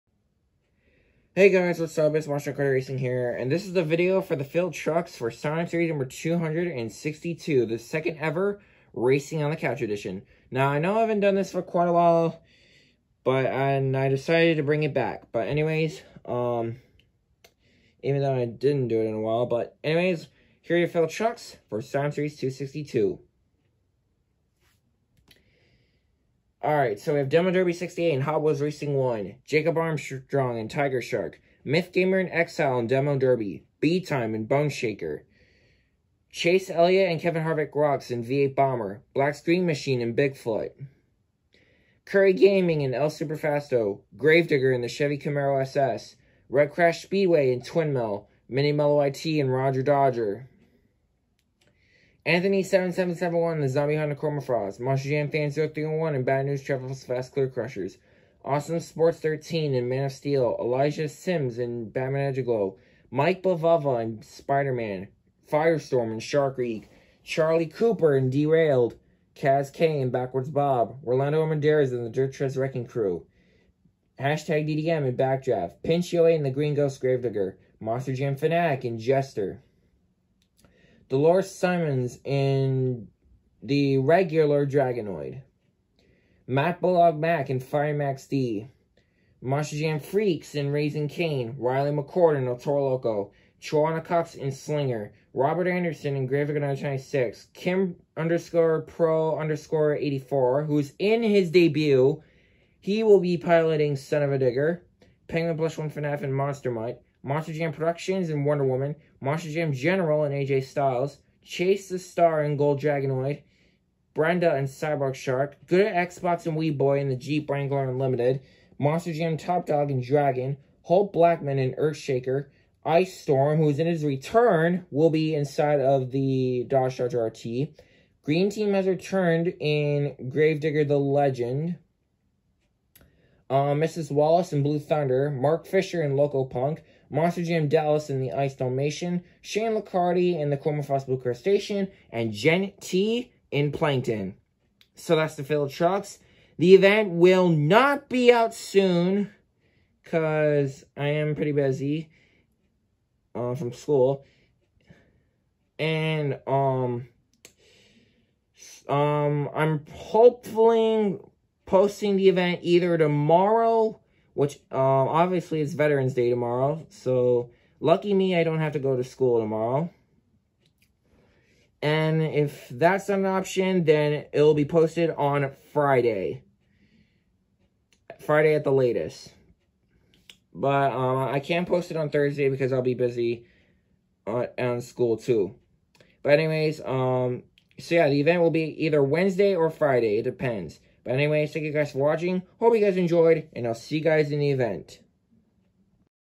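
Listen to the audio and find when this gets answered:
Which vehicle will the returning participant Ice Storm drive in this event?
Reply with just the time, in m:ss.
2:06.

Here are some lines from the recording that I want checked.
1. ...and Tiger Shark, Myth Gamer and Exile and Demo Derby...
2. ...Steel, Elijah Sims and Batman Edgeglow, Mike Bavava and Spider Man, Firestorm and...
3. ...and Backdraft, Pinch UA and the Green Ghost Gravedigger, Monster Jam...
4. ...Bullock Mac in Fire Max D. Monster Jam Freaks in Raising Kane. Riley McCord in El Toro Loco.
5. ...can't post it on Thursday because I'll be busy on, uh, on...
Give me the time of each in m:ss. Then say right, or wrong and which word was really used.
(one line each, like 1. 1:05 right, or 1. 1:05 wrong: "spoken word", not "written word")
1. 0:30 right
2. 1:00 right
3. 1:15 right
4. 1:26 right
5. 3:01 right.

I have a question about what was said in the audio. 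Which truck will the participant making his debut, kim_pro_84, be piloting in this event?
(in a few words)
Son of a Digger.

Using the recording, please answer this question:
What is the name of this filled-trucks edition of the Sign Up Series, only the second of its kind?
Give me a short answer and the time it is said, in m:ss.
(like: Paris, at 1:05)
Racing on the Couch, at 0:08.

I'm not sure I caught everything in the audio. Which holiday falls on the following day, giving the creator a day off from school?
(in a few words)
Veterans Day.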